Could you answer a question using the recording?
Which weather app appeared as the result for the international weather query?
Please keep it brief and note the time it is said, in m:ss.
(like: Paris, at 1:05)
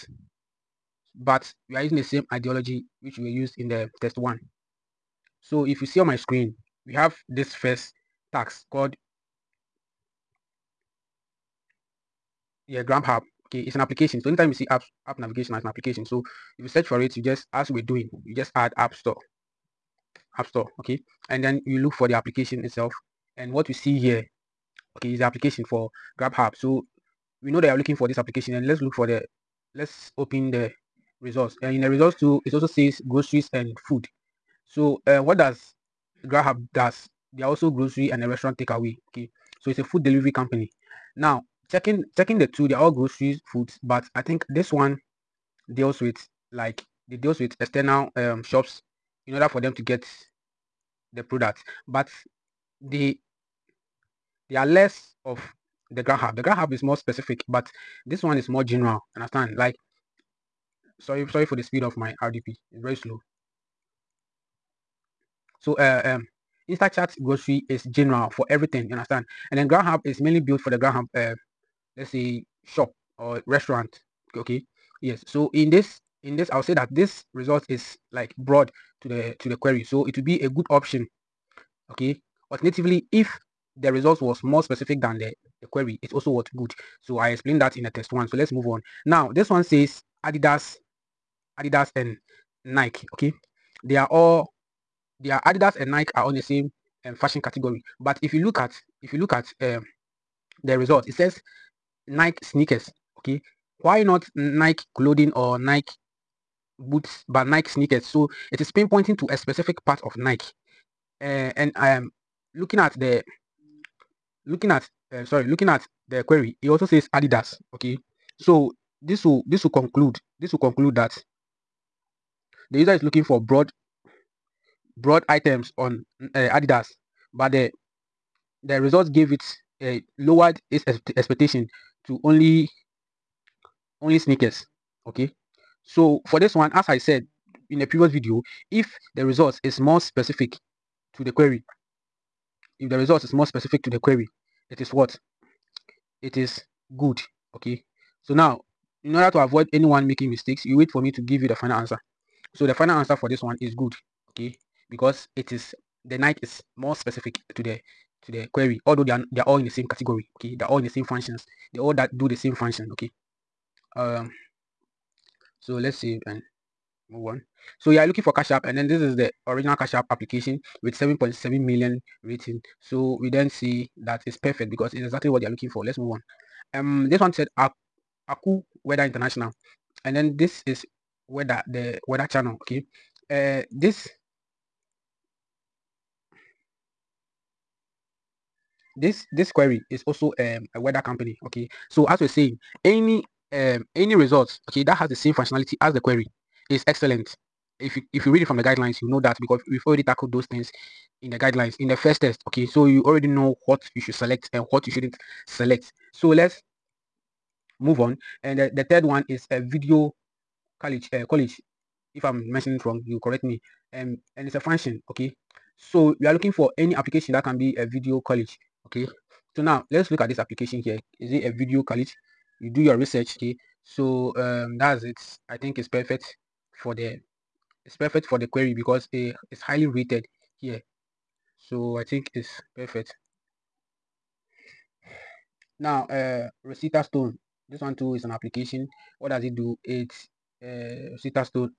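The Weather Channel, at 3:01.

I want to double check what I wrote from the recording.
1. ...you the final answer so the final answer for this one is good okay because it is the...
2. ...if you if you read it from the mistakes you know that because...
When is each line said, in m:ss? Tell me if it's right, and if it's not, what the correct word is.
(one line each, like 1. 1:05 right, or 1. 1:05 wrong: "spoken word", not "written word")
1. 2:31 right
2. 3:17 wrong: "guidelines", not "mistakes".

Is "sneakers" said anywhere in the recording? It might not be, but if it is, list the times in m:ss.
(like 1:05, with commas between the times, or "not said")
1:42, 1:47, 2:14.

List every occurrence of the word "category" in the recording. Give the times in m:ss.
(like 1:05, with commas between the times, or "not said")
1:37, 2:39.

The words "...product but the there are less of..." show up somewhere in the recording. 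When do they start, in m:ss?
0:51.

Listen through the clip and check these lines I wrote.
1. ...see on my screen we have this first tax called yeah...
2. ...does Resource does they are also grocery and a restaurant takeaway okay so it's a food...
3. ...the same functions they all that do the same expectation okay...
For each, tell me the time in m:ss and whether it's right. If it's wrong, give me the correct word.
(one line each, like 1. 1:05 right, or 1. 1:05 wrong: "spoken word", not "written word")
1. 0:05 right
2. 0:35 wrong: "Grubhub", not "Resource"
3. 2:40 wrong: "function", not "expectation".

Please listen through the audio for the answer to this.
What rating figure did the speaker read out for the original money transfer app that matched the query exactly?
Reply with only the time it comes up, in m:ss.
2:50.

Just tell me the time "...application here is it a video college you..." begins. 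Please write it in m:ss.
3:40.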